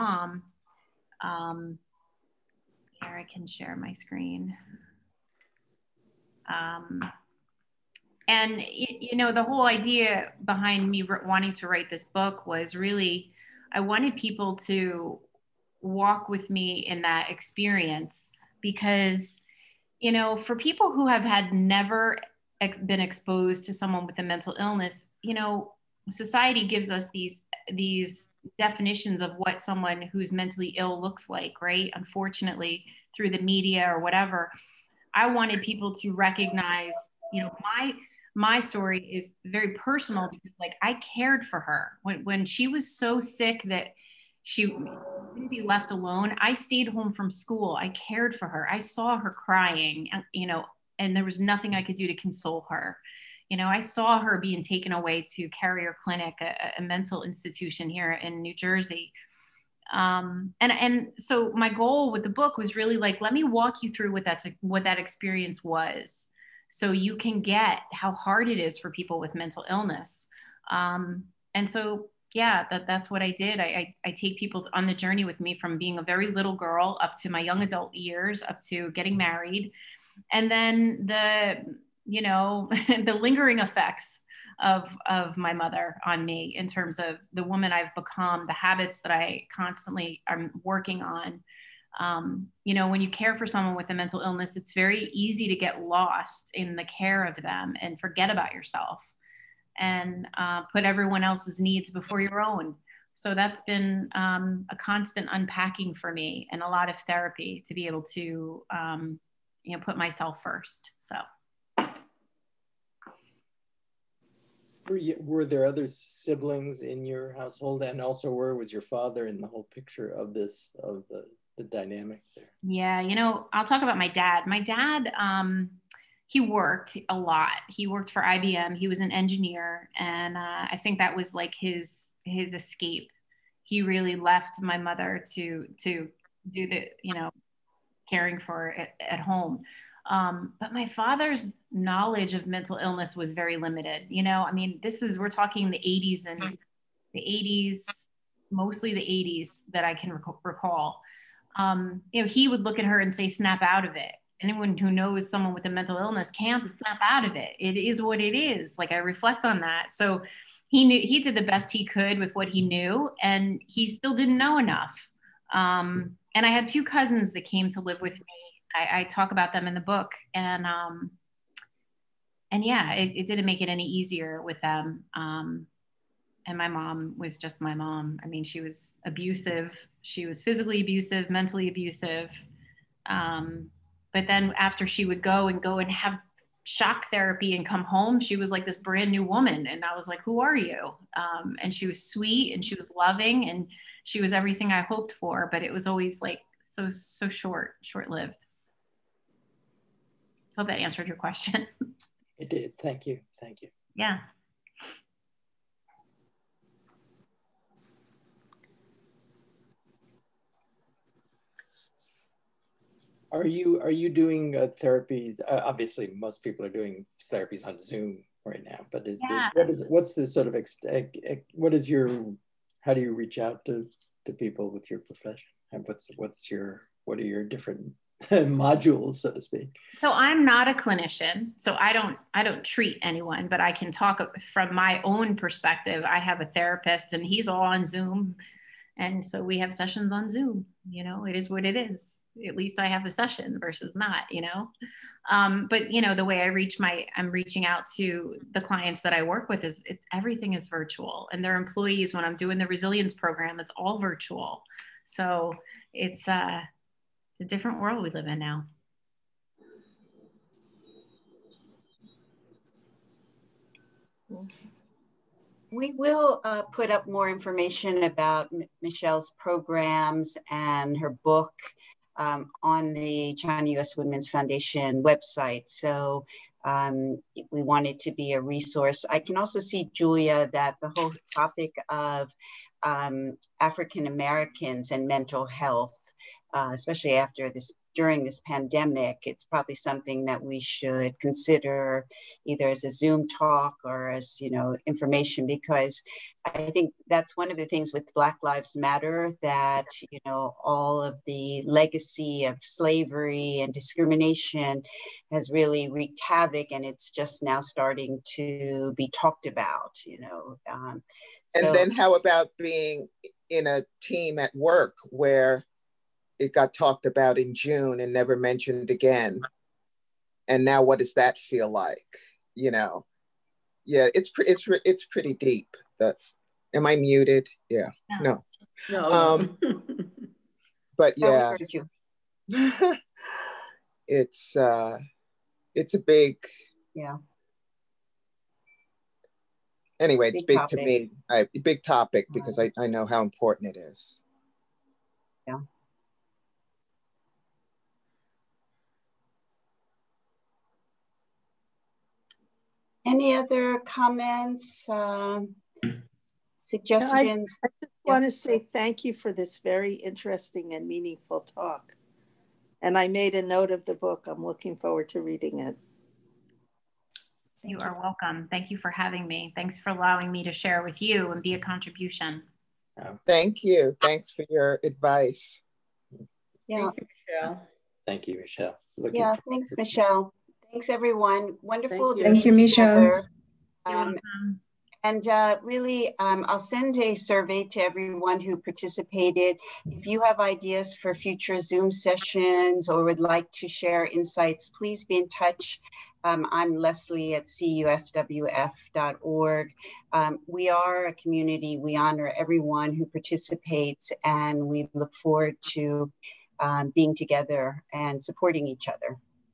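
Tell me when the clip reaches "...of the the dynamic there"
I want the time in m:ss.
2:00.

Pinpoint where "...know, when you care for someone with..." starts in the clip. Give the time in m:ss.
1:32.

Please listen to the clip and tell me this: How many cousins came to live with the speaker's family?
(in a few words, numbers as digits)
2.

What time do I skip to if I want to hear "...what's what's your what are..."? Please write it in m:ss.
3:45.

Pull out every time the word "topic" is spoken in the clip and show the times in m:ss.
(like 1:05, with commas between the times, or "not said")
4:41, 5:41.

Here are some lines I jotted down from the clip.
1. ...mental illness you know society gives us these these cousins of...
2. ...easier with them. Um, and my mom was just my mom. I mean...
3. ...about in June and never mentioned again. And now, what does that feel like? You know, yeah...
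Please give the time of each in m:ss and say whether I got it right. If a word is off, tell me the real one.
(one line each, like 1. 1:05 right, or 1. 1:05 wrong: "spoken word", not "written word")
1. 0:24 wrong: "definitions", not "cousins"
2. 2:53 right
3. 5:17 right.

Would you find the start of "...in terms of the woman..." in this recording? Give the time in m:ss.
1:26.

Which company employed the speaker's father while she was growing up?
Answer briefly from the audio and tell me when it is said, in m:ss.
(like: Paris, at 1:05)
IBM, at 2:08.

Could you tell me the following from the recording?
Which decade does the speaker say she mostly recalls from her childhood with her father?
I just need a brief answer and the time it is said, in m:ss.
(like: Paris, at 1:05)
The 80s, at 2:28.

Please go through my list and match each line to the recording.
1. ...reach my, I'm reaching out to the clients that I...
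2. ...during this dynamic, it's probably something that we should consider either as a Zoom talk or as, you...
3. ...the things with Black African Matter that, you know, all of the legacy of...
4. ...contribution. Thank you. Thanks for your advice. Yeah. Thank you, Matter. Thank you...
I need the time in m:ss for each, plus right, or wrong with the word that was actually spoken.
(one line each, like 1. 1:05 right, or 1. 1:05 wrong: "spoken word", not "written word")
1. 4:06 right
2. 4:47 wrong: "pandemic", not "dynamic"
3. 4:57 wrong: "Lives", not "African"
4. 6:11 wrong: "Michelle", not "Matter".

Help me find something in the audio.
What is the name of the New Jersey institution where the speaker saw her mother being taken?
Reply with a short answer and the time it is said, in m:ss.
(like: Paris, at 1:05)
Carrier Clinic, at 0:55.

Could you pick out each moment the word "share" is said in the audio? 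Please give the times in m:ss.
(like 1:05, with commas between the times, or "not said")
0:03, 6:10, 6:33.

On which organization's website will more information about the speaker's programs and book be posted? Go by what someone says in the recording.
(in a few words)
China US Women's Foundation.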